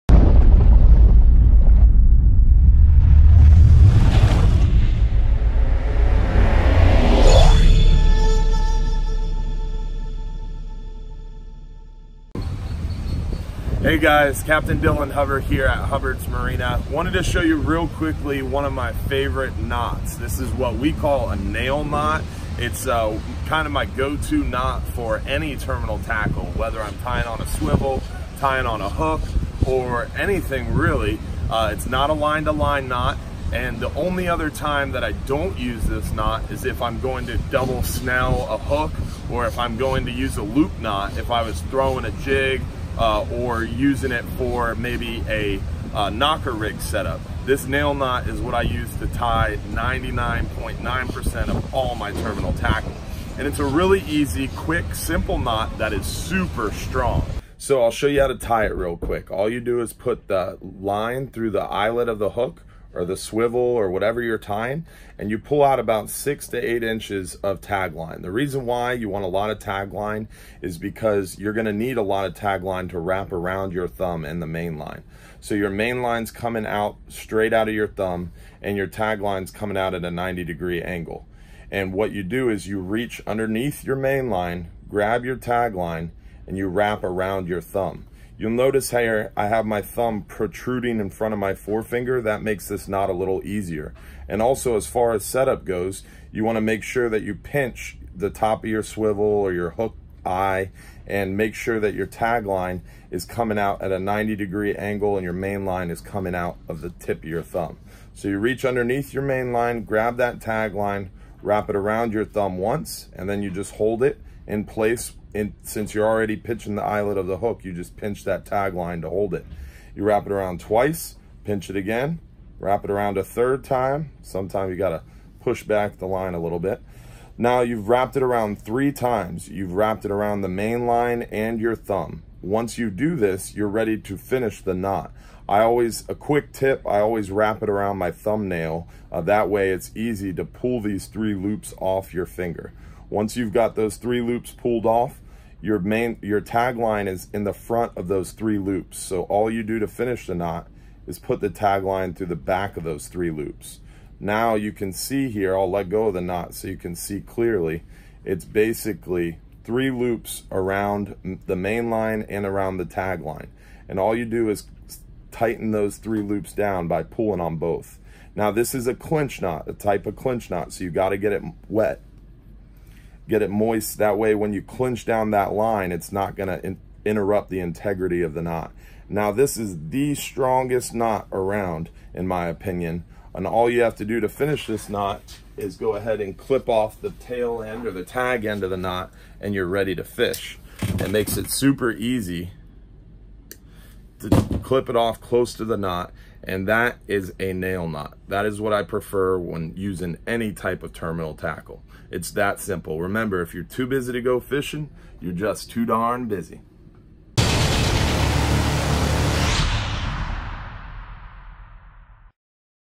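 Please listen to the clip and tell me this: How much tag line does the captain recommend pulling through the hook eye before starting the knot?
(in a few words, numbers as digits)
6 to 8 inches.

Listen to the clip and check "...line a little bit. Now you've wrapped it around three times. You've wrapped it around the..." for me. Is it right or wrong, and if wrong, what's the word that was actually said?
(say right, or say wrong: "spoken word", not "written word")
right.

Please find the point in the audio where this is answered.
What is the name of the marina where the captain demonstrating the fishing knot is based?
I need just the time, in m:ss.
0:15.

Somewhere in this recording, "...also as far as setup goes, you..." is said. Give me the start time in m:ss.
1:34.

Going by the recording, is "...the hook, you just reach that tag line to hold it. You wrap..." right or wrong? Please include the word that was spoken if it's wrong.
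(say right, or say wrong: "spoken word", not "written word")
wrong: "pinch", not "reach".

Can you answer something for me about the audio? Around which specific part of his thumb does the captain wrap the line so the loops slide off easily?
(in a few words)
thumbnail.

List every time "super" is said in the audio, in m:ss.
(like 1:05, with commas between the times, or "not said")
0:56, 3:11.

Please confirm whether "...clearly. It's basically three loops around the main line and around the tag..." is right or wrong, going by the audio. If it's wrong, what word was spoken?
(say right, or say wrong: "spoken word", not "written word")
right.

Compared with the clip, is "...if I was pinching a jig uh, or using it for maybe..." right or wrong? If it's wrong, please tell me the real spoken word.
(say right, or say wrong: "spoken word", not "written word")
wrong: "throwing", not "pinching".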